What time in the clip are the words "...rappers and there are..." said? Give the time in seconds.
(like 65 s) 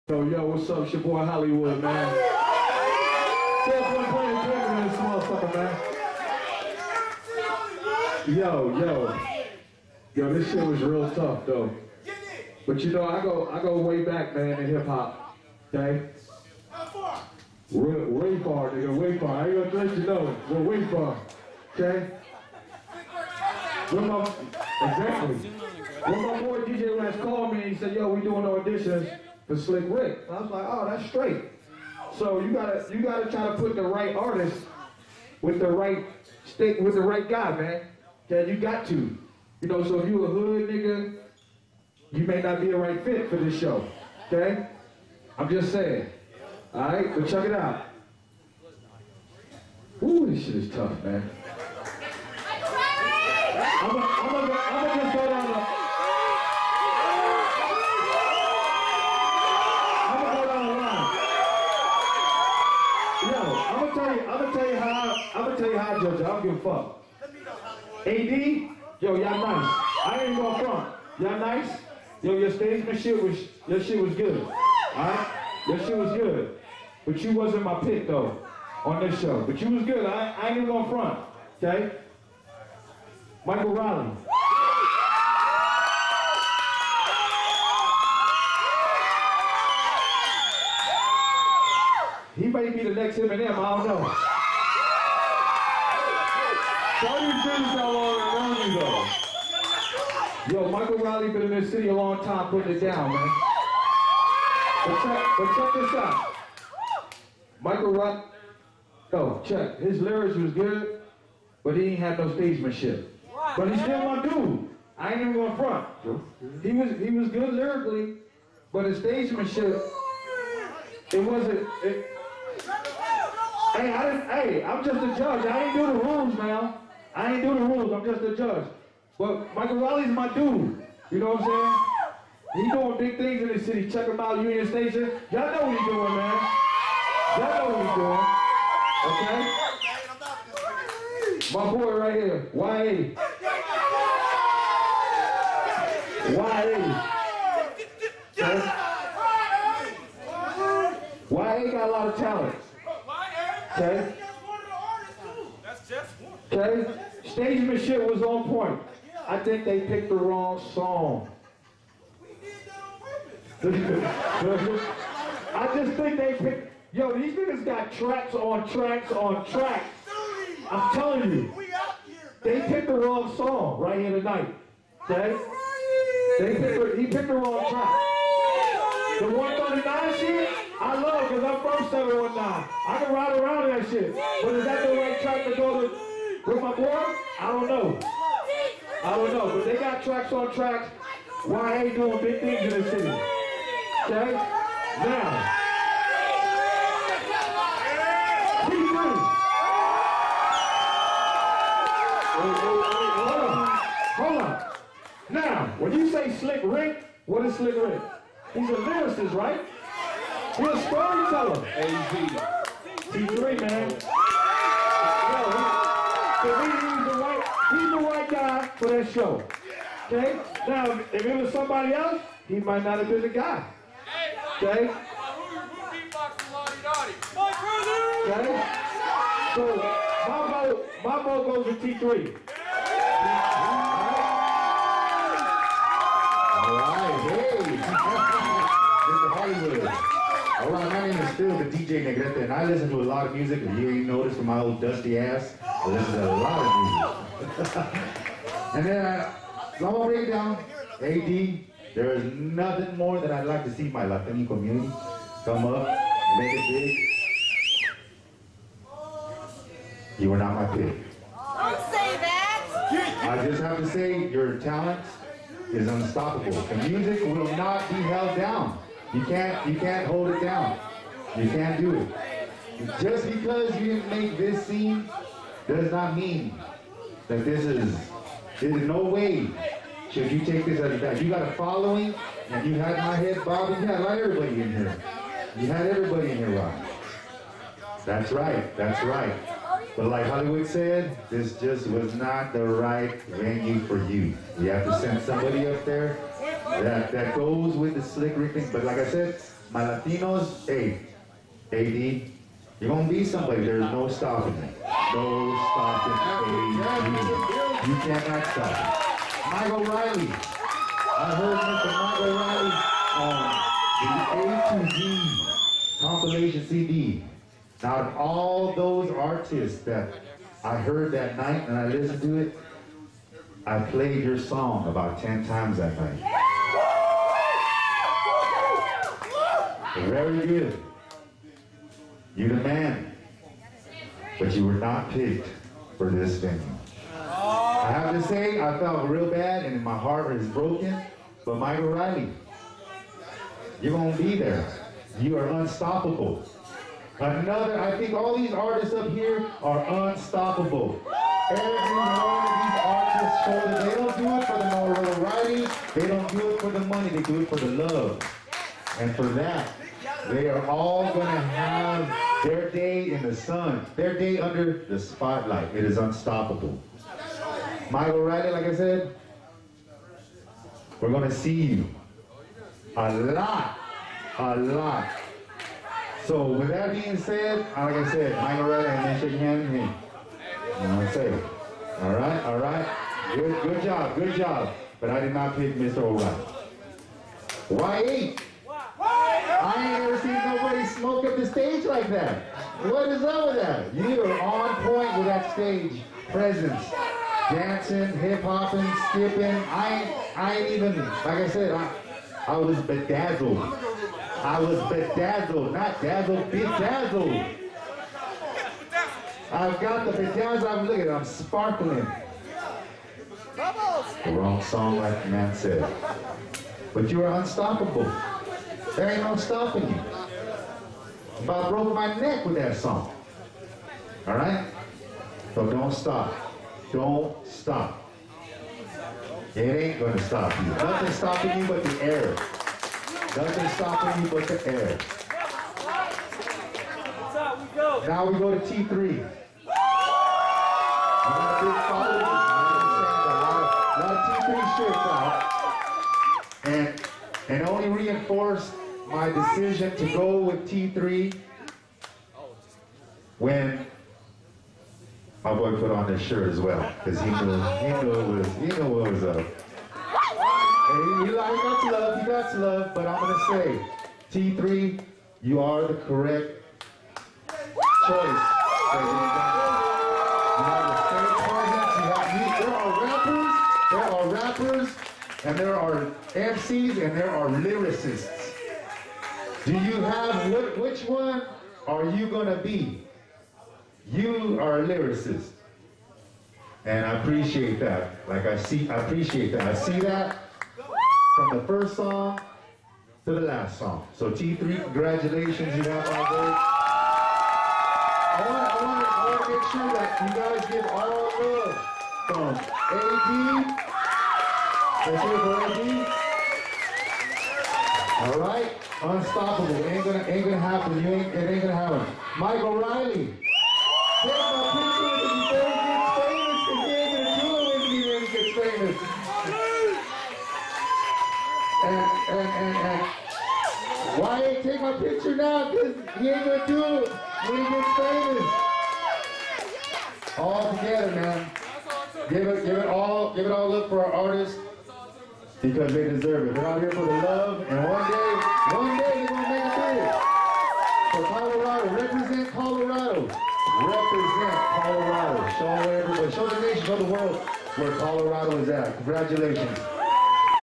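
474 s.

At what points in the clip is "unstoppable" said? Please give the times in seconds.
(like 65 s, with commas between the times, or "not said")
265 s, 345 s, 350 s, 365 s, 417 s, 509 s.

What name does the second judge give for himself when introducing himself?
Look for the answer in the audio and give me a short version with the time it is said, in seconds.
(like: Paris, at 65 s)
Phil, at 241 s.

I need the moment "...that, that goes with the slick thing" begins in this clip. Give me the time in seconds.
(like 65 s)
296 s.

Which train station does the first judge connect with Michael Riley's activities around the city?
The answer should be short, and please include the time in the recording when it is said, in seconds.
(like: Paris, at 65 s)
Union Station, at 134 s.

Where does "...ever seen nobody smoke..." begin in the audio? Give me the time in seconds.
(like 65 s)
390 s.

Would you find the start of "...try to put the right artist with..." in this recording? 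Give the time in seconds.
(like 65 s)
33 s.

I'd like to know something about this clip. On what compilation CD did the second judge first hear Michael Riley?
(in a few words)
A to Z.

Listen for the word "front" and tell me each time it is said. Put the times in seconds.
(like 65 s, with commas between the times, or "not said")
70 s, 80 s, 115 s.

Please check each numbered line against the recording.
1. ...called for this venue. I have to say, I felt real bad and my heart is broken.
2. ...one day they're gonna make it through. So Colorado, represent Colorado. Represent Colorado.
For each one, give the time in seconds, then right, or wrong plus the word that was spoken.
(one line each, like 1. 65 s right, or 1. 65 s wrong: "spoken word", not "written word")
1. 335 s wrong: "picked", not "called"
2. 538 s right.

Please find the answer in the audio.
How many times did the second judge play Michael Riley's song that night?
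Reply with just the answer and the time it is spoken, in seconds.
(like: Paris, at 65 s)
10, at 325 s.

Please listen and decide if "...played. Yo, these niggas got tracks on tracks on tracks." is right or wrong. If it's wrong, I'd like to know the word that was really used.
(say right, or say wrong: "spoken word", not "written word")
wrong: "picked", not "played".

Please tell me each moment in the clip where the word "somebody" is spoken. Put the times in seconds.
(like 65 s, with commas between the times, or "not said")
221 s, 295 s, 303 s.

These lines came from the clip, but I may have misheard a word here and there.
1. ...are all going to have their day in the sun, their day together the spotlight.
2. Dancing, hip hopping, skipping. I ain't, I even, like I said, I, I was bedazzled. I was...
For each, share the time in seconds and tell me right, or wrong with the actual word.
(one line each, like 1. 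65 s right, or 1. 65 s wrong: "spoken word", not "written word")
1. 360 s wrong: "under", not "together"
2. 397 s right.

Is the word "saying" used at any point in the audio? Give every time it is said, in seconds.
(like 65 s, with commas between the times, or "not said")
45 s, 131 s.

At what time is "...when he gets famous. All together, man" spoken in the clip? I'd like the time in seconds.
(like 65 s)
527 s.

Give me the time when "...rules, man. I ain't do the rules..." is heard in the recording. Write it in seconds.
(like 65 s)
126 s.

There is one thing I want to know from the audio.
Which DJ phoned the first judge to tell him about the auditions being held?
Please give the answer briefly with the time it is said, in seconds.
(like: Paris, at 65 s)
DJ Rex, at 26 s.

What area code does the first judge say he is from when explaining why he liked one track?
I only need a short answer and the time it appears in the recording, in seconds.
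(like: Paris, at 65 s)
719, at 181 s.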